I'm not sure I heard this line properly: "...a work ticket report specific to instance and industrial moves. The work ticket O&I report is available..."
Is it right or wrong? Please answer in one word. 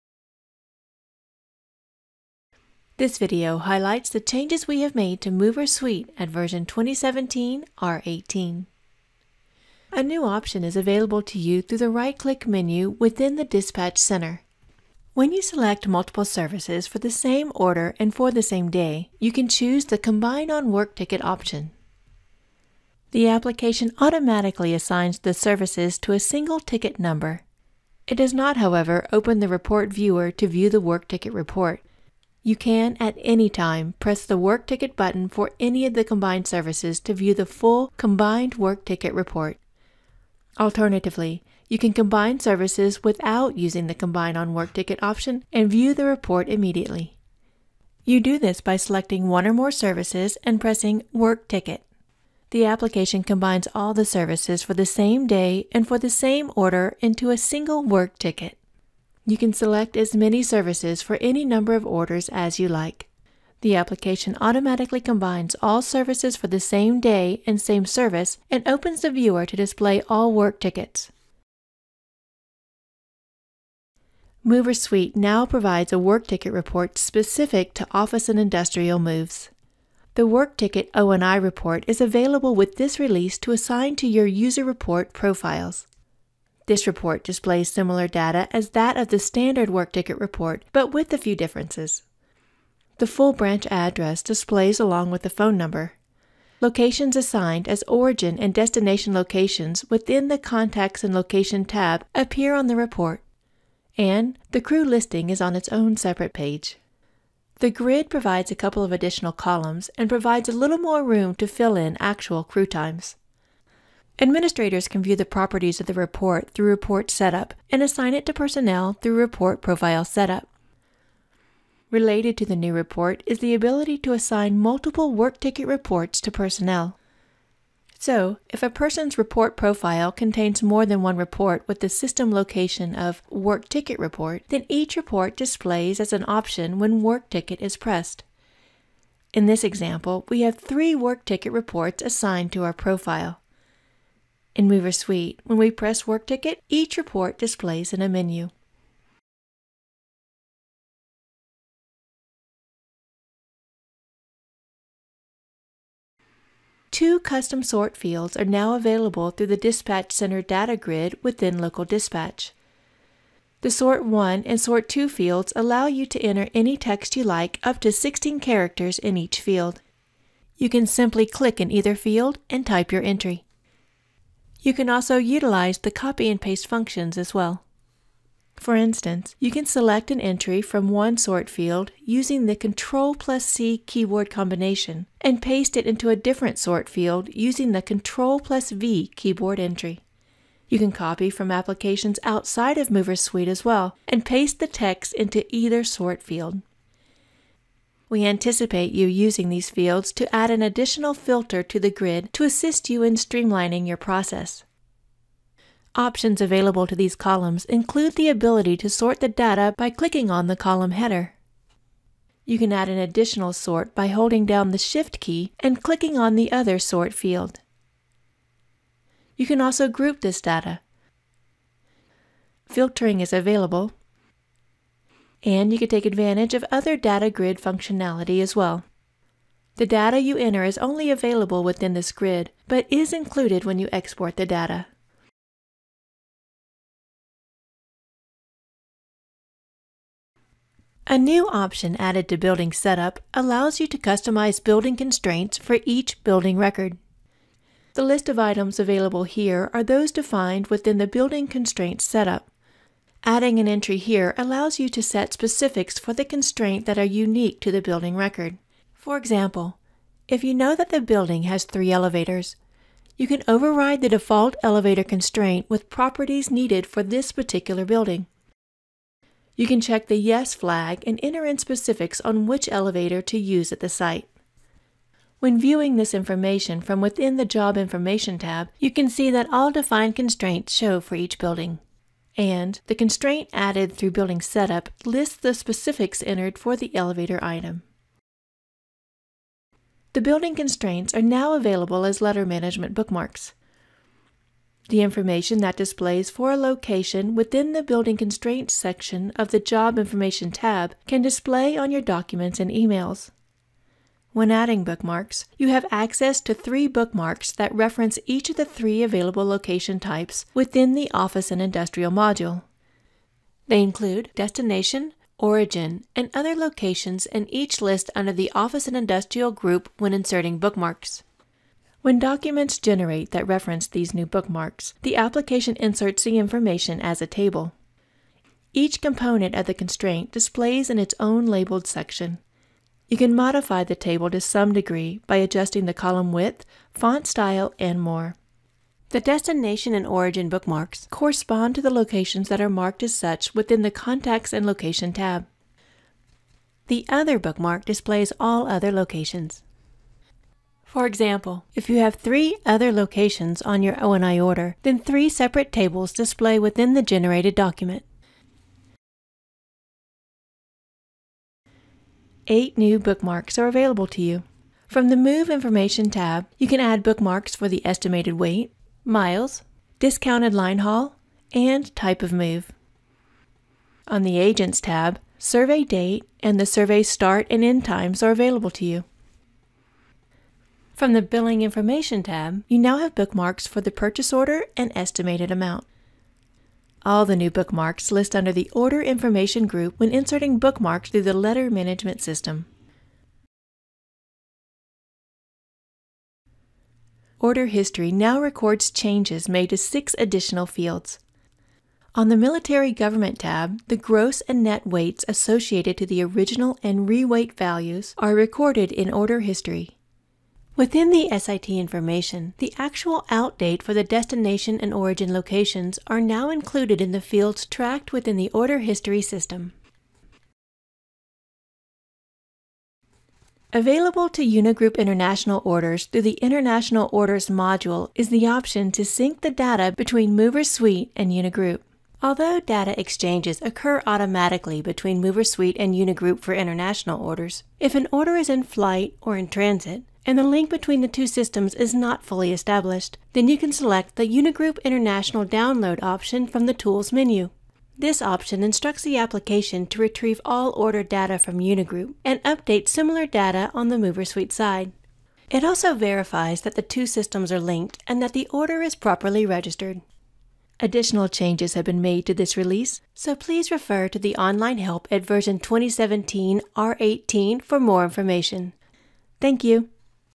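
wrong.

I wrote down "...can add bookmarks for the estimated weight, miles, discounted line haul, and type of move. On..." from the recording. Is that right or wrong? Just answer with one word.
right.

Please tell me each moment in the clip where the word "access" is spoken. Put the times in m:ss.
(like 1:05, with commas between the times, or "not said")
5:05.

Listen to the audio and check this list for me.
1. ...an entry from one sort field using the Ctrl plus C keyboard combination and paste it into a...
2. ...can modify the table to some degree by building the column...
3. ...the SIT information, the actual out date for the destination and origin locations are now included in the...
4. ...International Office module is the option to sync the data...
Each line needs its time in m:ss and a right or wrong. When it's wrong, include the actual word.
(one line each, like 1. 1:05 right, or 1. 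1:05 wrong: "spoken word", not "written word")
1. 3:00 right
2. 5:33 wrong: "adjusting", not "building"
3. 6:51 right
4. 7:06 wrong: "Orders", not "Office".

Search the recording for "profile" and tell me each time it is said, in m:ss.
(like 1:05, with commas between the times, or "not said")
1:25, 1:59, 2:09, 2:22.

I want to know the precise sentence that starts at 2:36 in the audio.
Two custom sort fields are now available through the Dispatch Center data grid within Local Dispatch.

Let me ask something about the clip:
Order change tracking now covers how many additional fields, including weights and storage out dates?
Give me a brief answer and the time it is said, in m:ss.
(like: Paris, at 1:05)
6, at 6:39.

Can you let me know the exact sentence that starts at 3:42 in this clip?
Filtering is available and you can take advantage of other data grid functionality as well.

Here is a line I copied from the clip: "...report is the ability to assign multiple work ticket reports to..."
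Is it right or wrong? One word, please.
right.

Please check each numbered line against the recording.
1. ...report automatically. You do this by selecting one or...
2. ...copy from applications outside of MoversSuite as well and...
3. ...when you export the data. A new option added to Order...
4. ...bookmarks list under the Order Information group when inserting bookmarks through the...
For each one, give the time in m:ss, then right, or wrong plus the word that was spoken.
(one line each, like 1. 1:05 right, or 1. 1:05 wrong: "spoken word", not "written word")
1. 0:46 wrong: "immediately", not "automatically"
2. 3:10 right
3. 3:53 wrong: "Building", not "Order"
4. 6:27 right.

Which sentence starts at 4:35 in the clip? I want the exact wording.
When viewing this information from within the Job Information tab, you can see that all defined constraints show for each building.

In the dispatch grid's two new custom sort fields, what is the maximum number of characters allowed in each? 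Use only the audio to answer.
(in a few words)
16.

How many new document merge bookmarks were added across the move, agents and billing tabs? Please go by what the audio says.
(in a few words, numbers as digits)
8.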